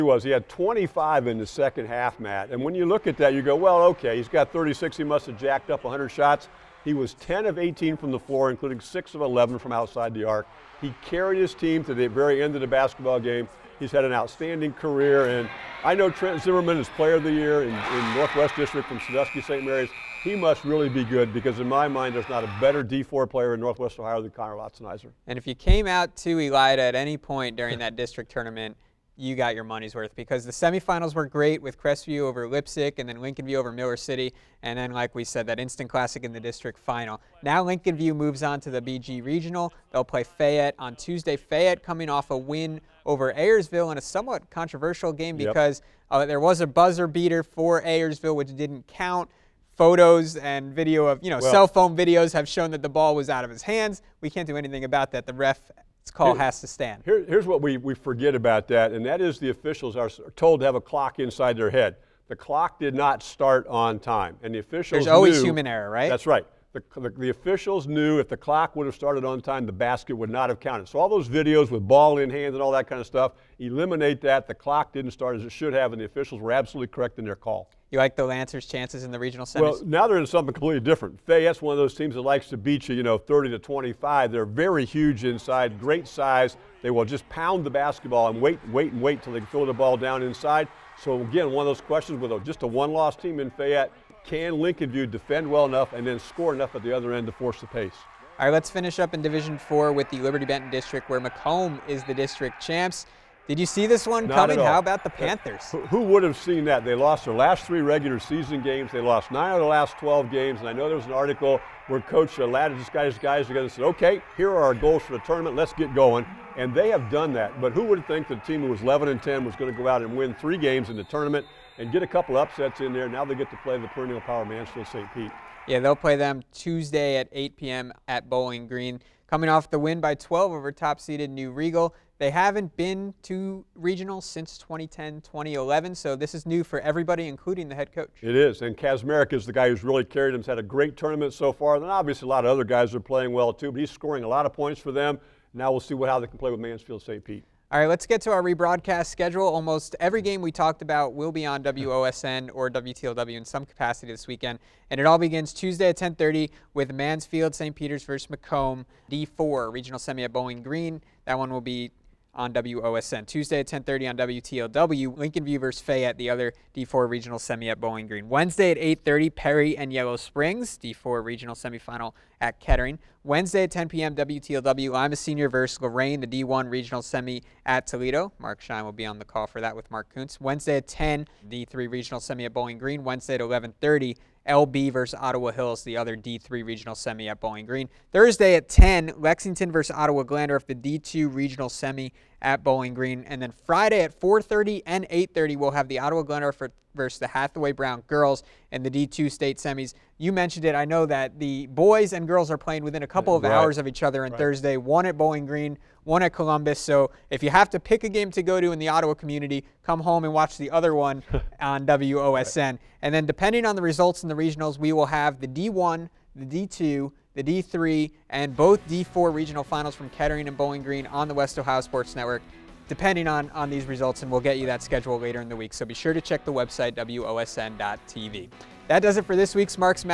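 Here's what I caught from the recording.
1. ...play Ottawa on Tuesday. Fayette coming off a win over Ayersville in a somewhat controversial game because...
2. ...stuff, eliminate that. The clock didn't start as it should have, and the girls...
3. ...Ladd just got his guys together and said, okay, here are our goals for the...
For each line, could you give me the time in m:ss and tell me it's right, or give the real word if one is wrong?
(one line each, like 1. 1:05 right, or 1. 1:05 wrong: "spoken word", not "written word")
1. 0:40 wrong: "Fayette", not "Ottawa"
2. 1:13 wrong: "officials", not "girls"
3. 1:52 right.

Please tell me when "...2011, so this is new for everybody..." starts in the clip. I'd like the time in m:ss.
2:15.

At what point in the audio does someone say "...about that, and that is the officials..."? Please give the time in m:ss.
0:58.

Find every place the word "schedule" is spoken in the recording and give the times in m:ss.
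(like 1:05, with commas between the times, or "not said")
2:29, 3:44.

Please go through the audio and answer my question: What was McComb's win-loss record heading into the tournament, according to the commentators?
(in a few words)
11-10.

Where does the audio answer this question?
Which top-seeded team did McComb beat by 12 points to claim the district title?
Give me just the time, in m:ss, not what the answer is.
2:11.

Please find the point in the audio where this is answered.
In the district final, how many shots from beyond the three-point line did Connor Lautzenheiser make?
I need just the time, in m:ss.
0:08.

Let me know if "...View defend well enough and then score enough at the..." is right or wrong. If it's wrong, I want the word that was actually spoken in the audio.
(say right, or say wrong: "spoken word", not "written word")
right.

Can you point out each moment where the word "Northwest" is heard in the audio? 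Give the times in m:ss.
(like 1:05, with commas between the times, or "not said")
0:18, 0:23.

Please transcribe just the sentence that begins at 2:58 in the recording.
Mark Shine will be on the call for that with Mark Kuntz.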